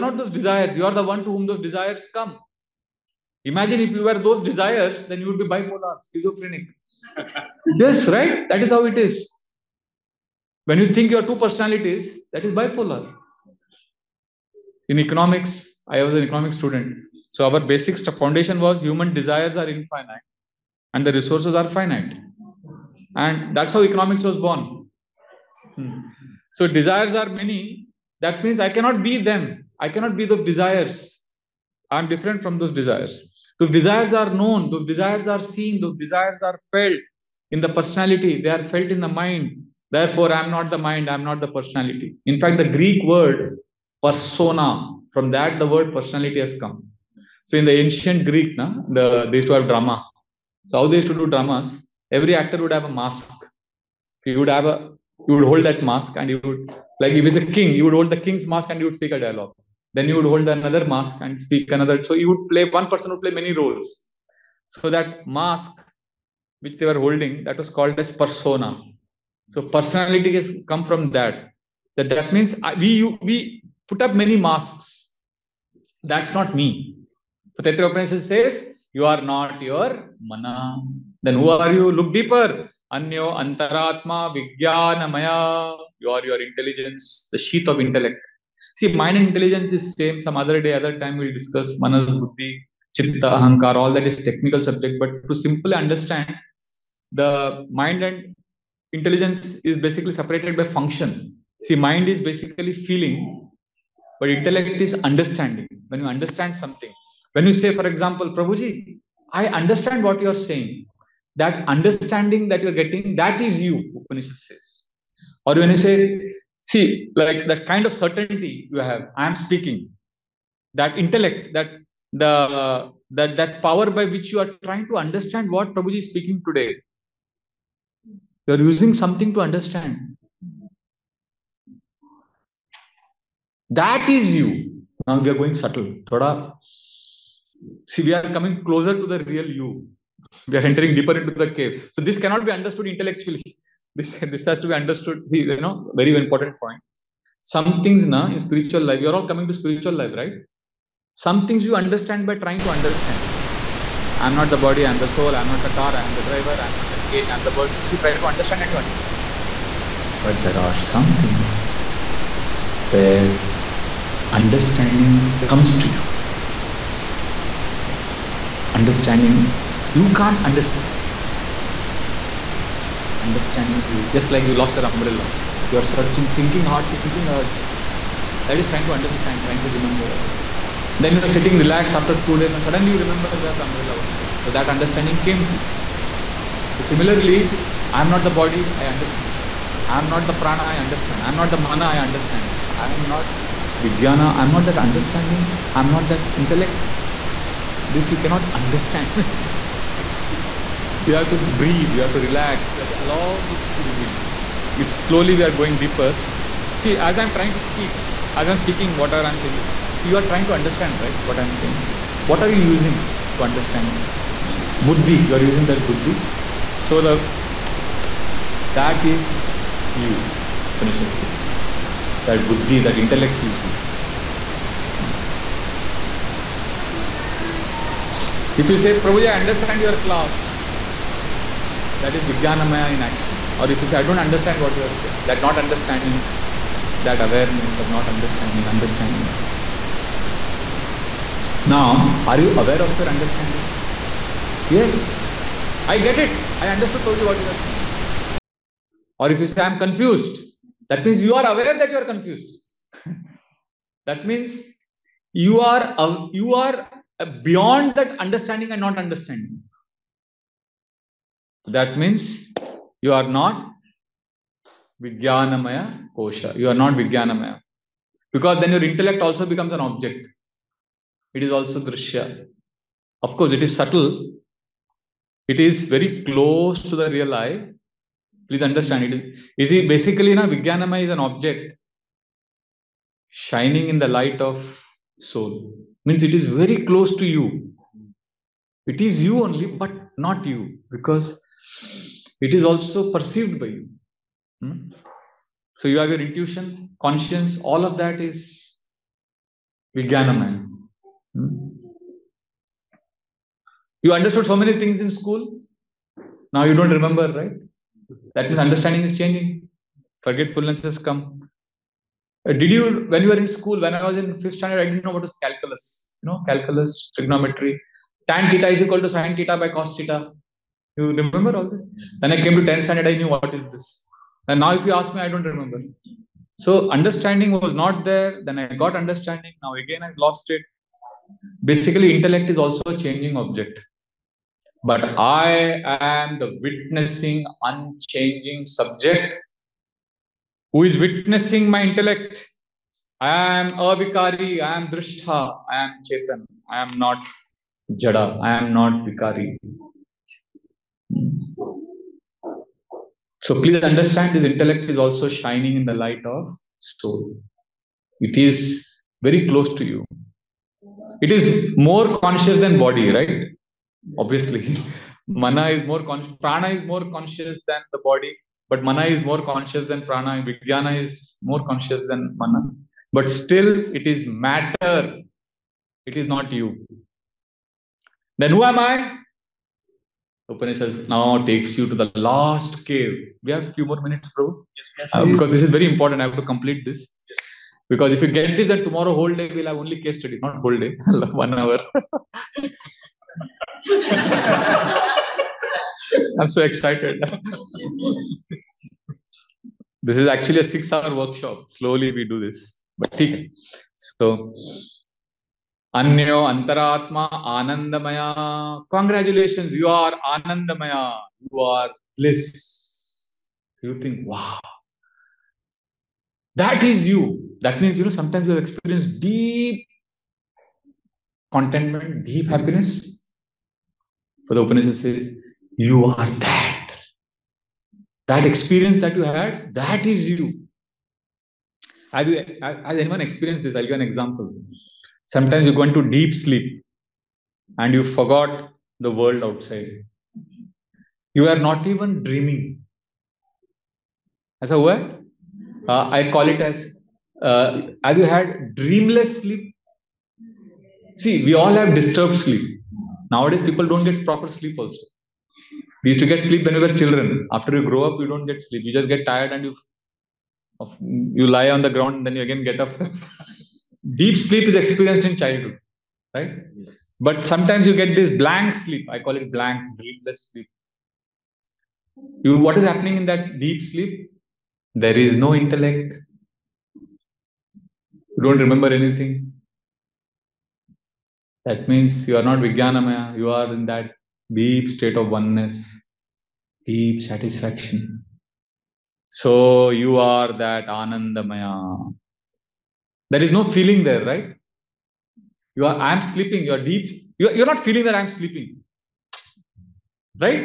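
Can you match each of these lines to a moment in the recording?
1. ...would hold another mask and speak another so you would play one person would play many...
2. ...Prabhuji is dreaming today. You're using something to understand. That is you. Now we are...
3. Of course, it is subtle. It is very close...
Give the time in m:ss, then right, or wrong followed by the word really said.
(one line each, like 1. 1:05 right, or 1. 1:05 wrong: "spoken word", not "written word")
1. 1:00 right
2. 2:05 wrong: "speaking", not "dreaming"
3. 4:33 right.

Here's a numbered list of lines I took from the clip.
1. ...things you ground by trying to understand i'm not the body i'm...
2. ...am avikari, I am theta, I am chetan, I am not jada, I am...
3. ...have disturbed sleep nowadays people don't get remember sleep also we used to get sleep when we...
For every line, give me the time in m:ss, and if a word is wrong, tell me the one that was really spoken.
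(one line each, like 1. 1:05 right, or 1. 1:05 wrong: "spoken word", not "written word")
1. 2:31 wrong: "understand", not "ground"
2. 5:43 wrong: "drishta", not "theta"
3. 7:31 wrong: "proper", not "remember".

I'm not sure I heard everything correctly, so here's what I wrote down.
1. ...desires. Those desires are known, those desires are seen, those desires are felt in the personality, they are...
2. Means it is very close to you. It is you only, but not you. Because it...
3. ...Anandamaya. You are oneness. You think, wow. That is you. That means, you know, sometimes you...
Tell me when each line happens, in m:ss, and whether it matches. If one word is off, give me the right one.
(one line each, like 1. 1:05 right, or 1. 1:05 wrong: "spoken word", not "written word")
1. 0:32 right
2. 4:46 right
3. 6:50 wrong: "bliss", not "oneness".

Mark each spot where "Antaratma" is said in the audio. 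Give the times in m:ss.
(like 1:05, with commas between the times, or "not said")
1:23, 6:46.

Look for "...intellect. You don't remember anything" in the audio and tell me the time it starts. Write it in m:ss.
7:55.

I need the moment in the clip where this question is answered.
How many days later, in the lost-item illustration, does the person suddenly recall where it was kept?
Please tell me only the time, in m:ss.
3:02.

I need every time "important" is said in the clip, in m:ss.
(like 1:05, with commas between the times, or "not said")
2:26, 6:25.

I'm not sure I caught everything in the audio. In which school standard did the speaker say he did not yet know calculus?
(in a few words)
Fifth standard.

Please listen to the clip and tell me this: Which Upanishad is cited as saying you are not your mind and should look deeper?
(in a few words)
Taittiriya Upanishad.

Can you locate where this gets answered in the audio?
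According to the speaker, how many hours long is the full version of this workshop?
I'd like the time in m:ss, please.
6:40.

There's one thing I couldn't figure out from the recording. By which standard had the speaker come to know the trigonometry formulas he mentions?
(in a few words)
10th standard.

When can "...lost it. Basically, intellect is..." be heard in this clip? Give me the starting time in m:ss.
5:30.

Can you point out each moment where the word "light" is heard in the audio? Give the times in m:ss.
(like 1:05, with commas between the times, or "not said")
4:44, 5:55.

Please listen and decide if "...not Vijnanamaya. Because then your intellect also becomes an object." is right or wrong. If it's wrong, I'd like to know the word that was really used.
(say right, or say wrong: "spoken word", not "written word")
right.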